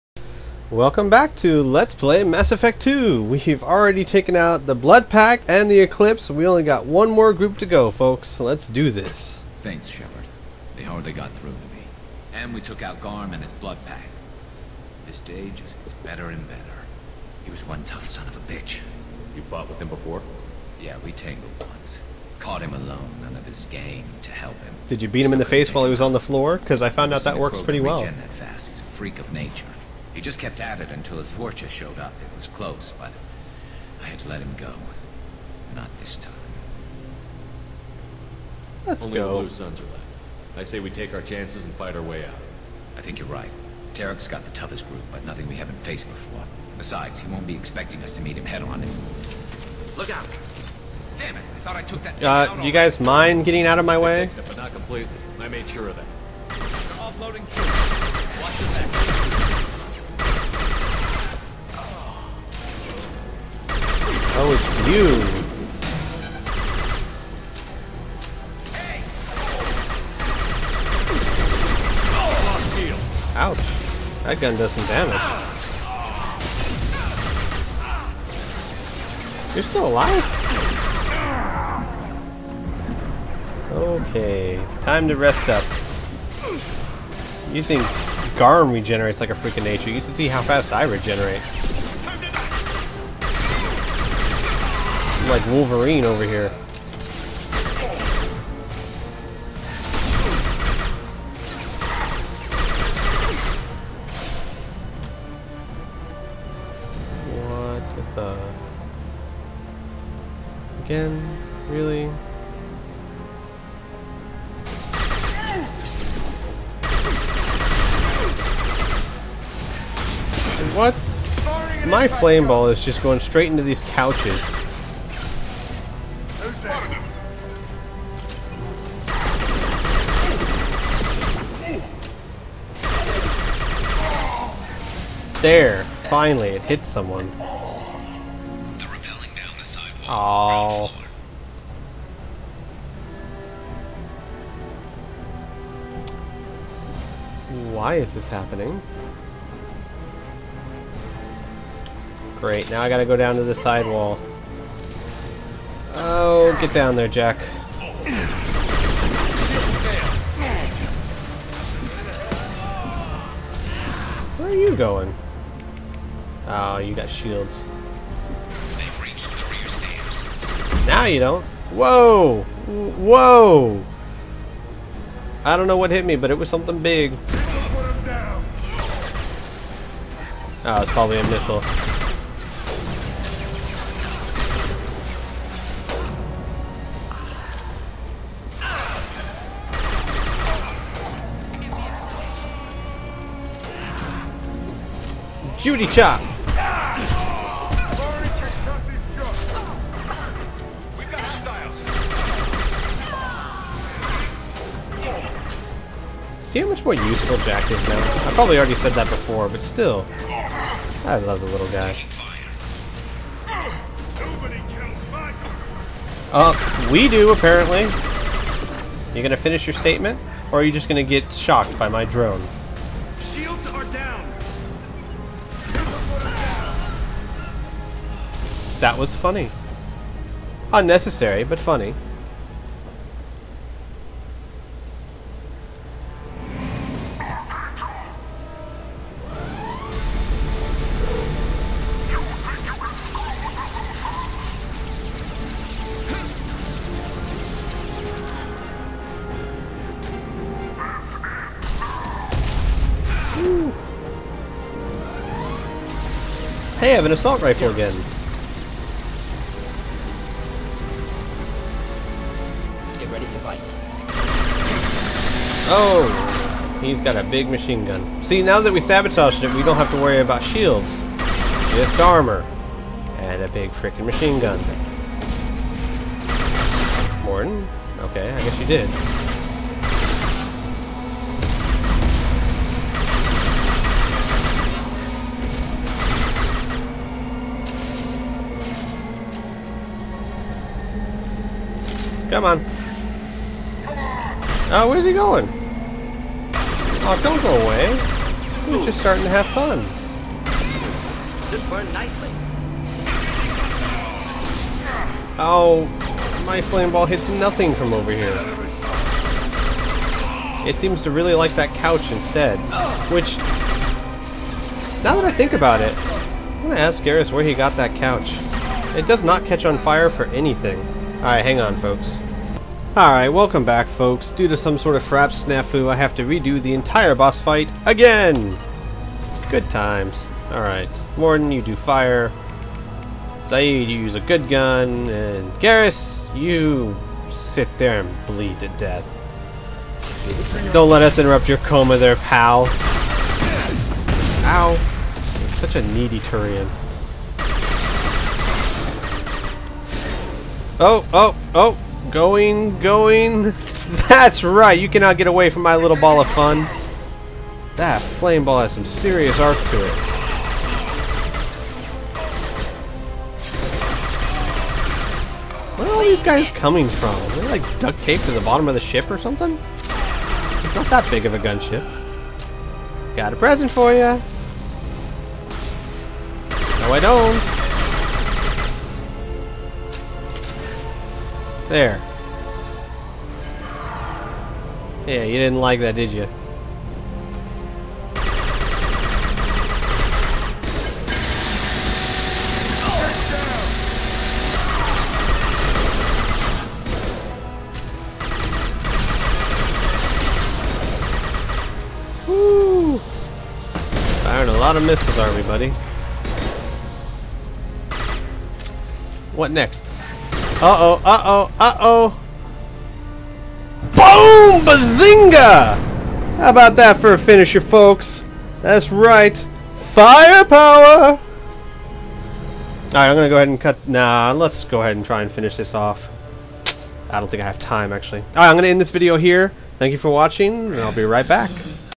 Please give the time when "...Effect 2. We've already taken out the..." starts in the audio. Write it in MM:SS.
00:02.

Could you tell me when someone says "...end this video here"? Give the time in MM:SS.
07:08.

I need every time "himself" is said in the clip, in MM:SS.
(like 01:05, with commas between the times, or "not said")
not said.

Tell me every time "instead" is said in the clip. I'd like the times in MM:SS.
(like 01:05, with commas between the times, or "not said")
05:12.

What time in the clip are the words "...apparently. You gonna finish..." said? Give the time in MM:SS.
03:37.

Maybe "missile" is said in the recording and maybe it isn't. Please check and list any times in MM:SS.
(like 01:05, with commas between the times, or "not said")
03:01, 06:44.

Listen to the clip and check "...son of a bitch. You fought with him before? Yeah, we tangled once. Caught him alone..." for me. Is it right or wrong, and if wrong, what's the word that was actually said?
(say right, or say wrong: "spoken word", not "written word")
right.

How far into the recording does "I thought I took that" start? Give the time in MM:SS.
00:51.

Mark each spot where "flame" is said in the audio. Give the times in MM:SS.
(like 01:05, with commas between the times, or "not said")
02:02, 05:06, 05:58.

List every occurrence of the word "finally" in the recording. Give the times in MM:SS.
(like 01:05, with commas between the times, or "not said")
02:16.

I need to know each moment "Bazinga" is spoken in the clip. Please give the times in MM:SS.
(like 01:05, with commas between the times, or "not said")
06:54.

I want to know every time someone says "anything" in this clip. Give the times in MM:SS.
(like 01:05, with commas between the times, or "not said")
05:20.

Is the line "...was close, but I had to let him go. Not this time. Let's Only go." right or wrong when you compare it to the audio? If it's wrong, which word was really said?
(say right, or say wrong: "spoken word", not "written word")
right.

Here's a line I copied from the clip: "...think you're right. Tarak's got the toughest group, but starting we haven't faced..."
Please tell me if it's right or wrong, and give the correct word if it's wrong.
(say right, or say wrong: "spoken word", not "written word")
wrong: "nothing", not "starting".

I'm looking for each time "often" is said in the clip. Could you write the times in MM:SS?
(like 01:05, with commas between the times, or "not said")
not said.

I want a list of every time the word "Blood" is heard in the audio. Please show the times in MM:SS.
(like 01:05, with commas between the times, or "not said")
00:04, 00:13.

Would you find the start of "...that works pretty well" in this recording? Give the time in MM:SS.
00:27.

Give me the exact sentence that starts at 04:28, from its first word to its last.
See, now that we sabotaged it, we don't have to worry about shields.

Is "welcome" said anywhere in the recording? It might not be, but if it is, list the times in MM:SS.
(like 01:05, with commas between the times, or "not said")
00:00, 05:23.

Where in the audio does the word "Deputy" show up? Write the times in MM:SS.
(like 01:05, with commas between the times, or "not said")
not said.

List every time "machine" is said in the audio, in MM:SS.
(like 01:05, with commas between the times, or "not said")
04:27, 04:34.